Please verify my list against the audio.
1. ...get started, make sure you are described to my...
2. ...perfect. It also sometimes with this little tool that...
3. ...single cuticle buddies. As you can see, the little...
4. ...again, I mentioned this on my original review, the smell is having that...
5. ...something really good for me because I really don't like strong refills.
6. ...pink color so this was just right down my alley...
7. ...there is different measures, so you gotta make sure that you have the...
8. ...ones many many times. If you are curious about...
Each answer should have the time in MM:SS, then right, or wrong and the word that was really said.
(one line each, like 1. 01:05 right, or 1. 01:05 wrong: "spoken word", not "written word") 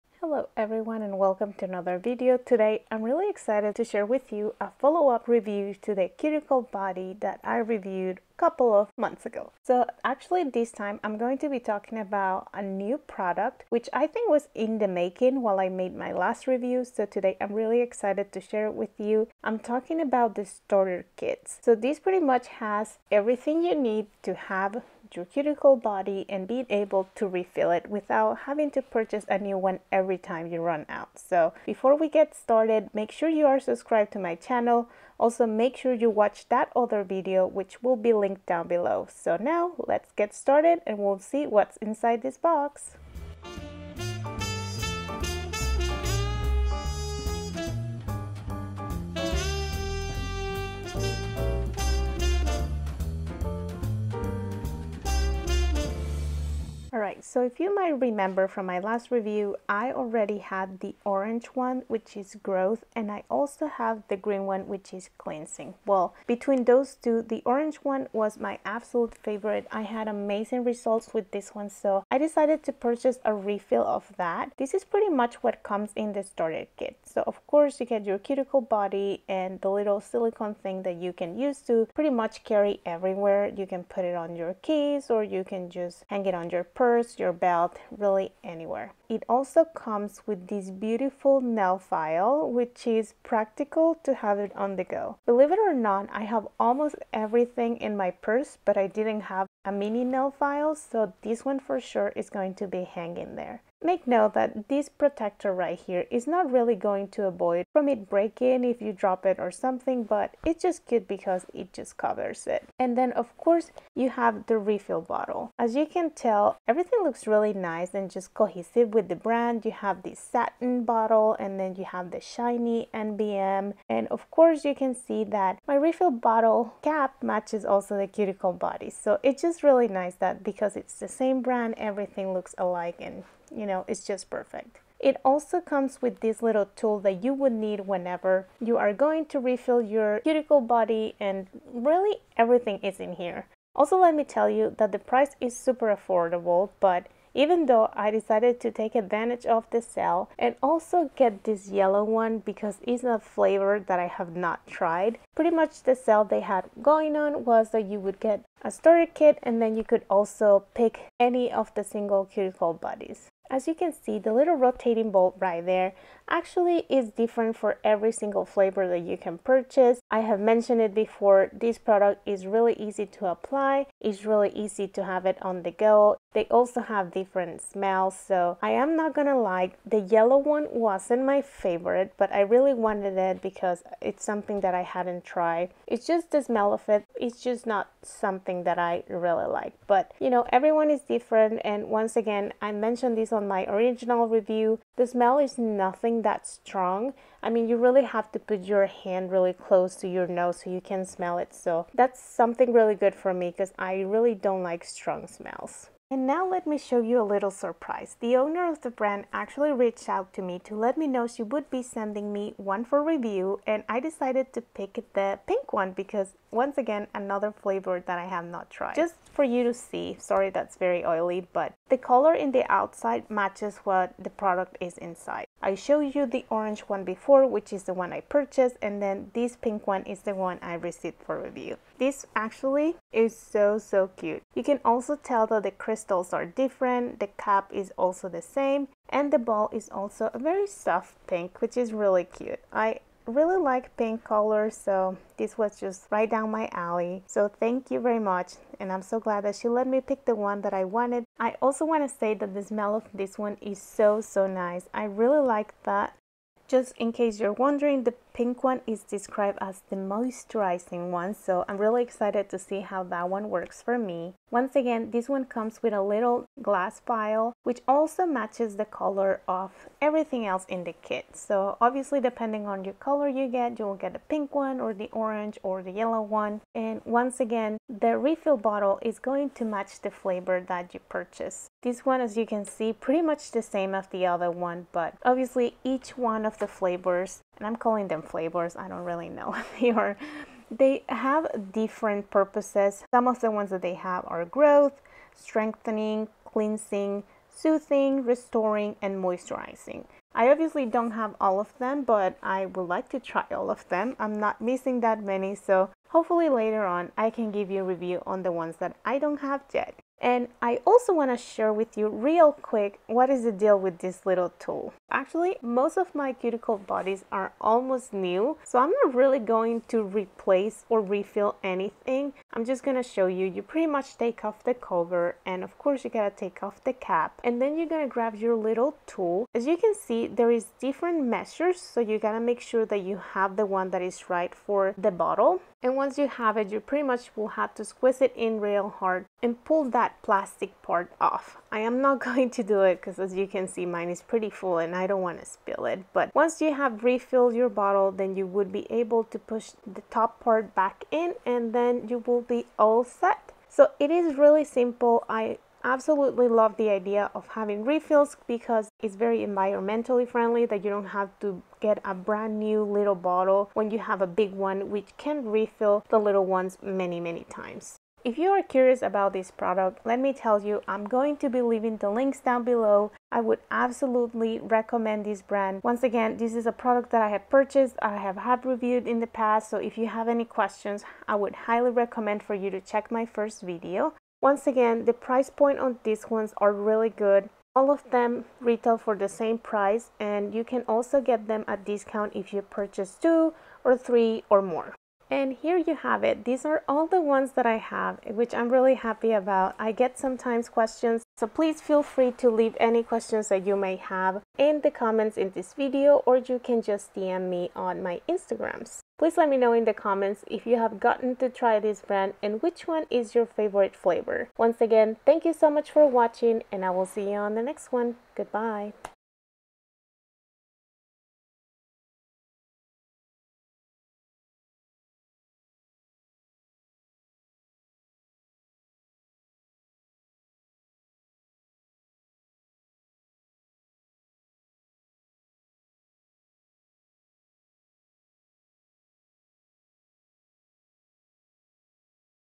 1. 00:32 wrong: "subscribed", not "described"
2. 02:14 wrong: "comes", not "sometimes"
3. 02:41 right
4. 03:12 wrong: "nothing", not "having"
5. 03:22 wrong: "smells", not "refills"
6. 04:03 right
7. 05:30 right
8. 06:06 right.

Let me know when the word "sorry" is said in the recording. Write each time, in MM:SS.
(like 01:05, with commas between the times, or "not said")
03:40.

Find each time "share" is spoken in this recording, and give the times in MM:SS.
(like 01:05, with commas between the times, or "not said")
00:03, 00:18, 05:11.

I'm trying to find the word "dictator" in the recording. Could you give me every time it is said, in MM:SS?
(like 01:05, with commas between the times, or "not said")
not said.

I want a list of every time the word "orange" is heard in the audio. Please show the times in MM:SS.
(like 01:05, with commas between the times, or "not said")
01:01, 01:07, 03:46, 04:35.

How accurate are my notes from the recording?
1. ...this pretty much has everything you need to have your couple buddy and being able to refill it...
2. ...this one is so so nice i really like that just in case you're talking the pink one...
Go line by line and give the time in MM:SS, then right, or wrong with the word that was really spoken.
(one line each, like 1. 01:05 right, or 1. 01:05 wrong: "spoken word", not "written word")
1. 00:21 wrong: "cuticle", not "couple"
2. 04:13 wrong: "wondering", not "talking".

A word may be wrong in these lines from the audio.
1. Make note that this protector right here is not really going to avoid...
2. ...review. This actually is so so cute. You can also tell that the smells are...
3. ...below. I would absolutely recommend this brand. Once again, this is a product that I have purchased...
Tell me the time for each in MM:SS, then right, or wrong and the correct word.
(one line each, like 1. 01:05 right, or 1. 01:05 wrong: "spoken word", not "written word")
1. 01:43 right
2. 03:51 wrong: "crystals", not "smells"
3. 06:12 right.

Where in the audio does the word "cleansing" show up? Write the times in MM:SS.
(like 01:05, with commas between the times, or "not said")
01:05, 04:56.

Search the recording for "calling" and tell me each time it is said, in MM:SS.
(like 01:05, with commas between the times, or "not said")
04:47.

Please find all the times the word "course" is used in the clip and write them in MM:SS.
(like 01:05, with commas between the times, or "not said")
01:17, 01:53, 02:04, 05:25.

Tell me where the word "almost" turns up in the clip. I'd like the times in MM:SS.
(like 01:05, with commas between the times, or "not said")
01:36, 05:17.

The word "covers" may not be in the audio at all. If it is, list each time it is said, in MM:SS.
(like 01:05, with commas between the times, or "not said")
01:51, 05:24.